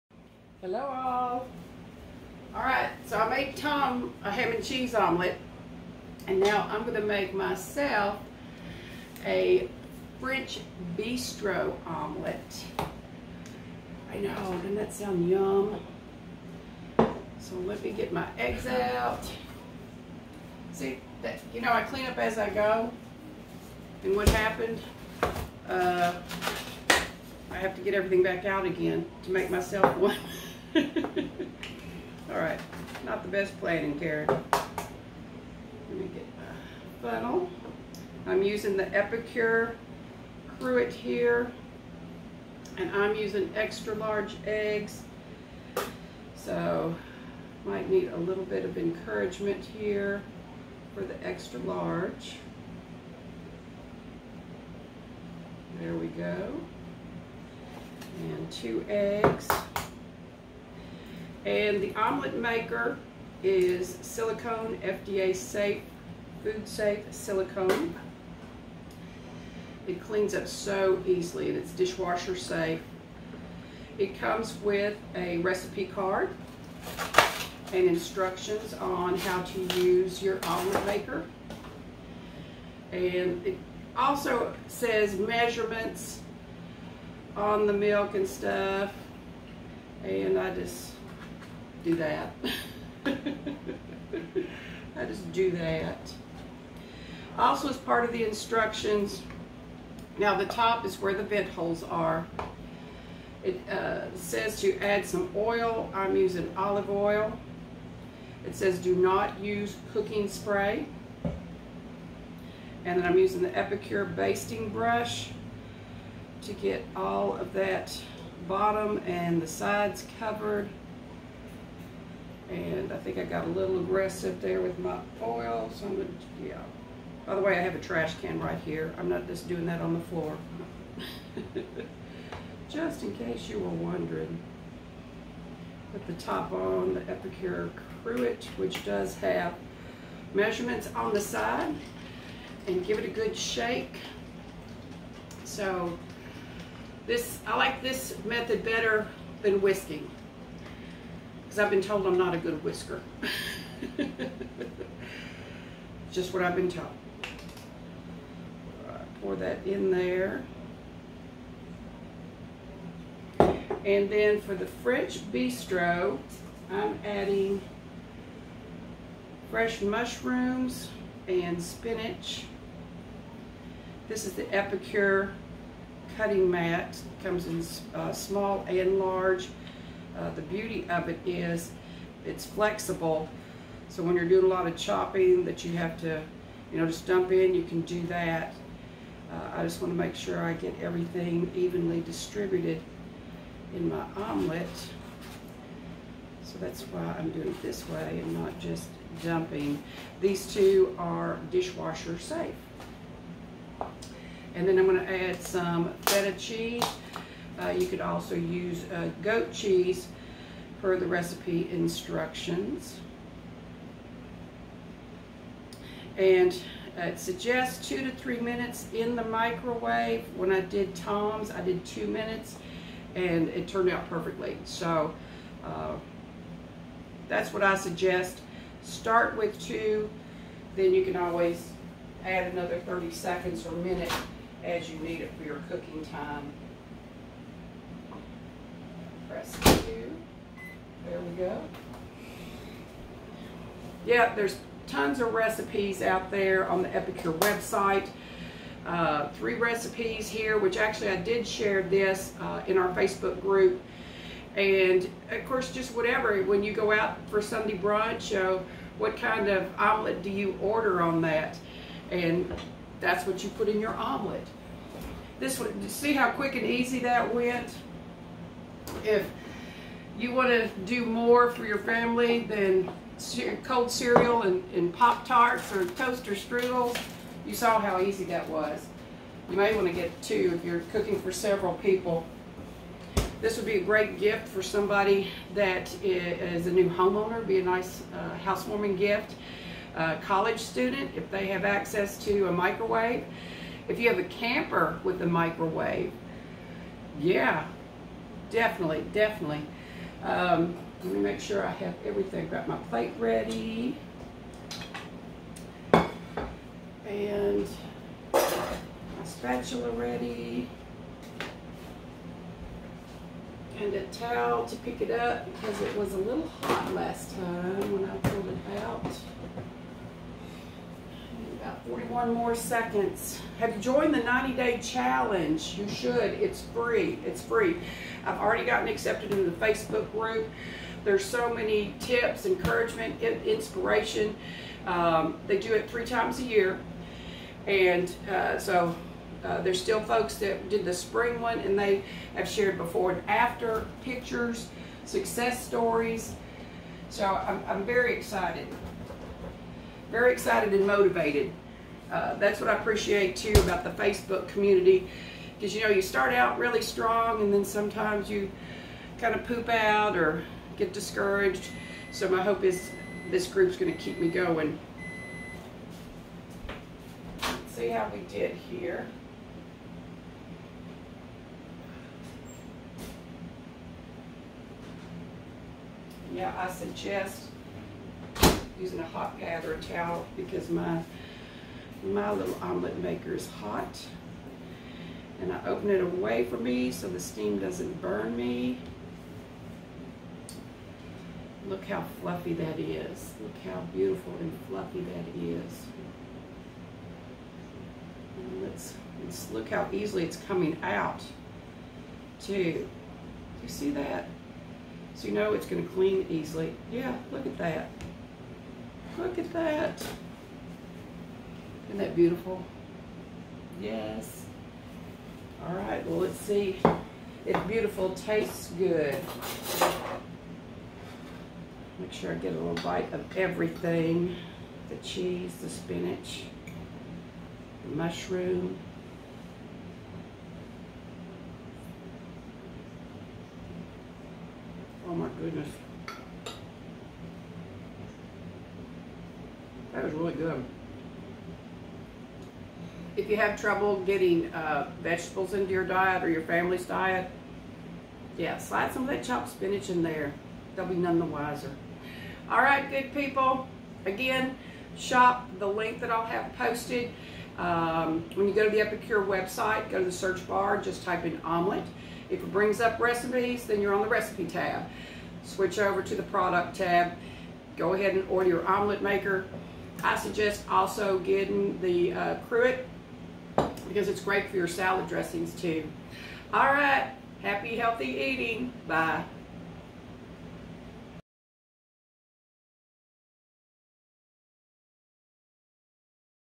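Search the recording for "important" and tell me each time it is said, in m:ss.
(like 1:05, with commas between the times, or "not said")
not said.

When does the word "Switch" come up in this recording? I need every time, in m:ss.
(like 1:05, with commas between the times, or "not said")
7:45.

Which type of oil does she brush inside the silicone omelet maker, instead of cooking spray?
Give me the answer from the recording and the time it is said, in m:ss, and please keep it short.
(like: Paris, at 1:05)
Olive oil, at 1:46.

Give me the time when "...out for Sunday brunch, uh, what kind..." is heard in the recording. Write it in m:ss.
4:16.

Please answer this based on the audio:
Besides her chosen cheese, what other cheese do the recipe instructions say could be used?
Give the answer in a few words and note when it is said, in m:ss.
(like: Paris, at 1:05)
Goat cheese, at 3:29.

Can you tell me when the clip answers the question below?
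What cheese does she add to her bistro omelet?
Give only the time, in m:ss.
3:26.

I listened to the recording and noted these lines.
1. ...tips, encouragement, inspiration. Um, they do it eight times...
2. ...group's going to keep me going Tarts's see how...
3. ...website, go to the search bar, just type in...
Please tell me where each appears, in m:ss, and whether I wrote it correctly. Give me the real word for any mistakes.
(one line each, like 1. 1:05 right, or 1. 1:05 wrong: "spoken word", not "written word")
1. 5:31 wrong: "three", not "eight"
2. 6:03 wrong: "Let", not "Tarts"
3. 7:39 right.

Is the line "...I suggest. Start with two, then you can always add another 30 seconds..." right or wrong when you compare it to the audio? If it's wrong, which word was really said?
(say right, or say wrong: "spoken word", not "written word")
right.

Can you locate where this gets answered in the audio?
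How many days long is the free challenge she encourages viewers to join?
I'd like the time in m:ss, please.
5:24.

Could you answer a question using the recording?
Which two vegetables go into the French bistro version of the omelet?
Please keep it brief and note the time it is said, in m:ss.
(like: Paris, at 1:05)
Mushrooms and spinach, at 2:49.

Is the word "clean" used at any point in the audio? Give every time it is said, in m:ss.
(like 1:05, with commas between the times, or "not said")
0:21, 1:10, 6:45.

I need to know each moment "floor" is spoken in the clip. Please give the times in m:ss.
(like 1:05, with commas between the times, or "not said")
2:10.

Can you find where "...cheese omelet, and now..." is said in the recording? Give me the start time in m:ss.
0:04.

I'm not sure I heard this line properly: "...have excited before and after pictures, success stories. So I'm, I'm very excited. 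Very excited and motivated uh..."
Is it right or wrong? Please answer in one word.
wrong.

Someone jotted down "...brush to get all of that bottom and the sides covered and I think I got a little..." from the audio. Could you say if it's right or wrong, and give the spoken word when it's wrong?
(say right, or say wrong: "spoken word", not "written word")
right.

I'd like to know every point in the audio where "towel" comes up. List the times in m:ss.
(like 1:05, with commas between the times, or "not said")
5:14, 6:19.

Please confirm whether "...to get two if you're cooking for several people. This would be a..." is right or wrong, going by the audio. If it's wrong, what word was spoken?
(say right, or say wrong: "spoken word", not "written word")
right.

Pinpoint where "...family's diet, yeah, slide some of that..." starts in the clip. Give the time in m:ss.
7:26.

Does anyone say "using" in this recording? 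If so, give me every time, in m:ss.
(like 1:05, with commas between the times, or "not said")
0:38, 0:43, 1:46, 1:53, 6:18.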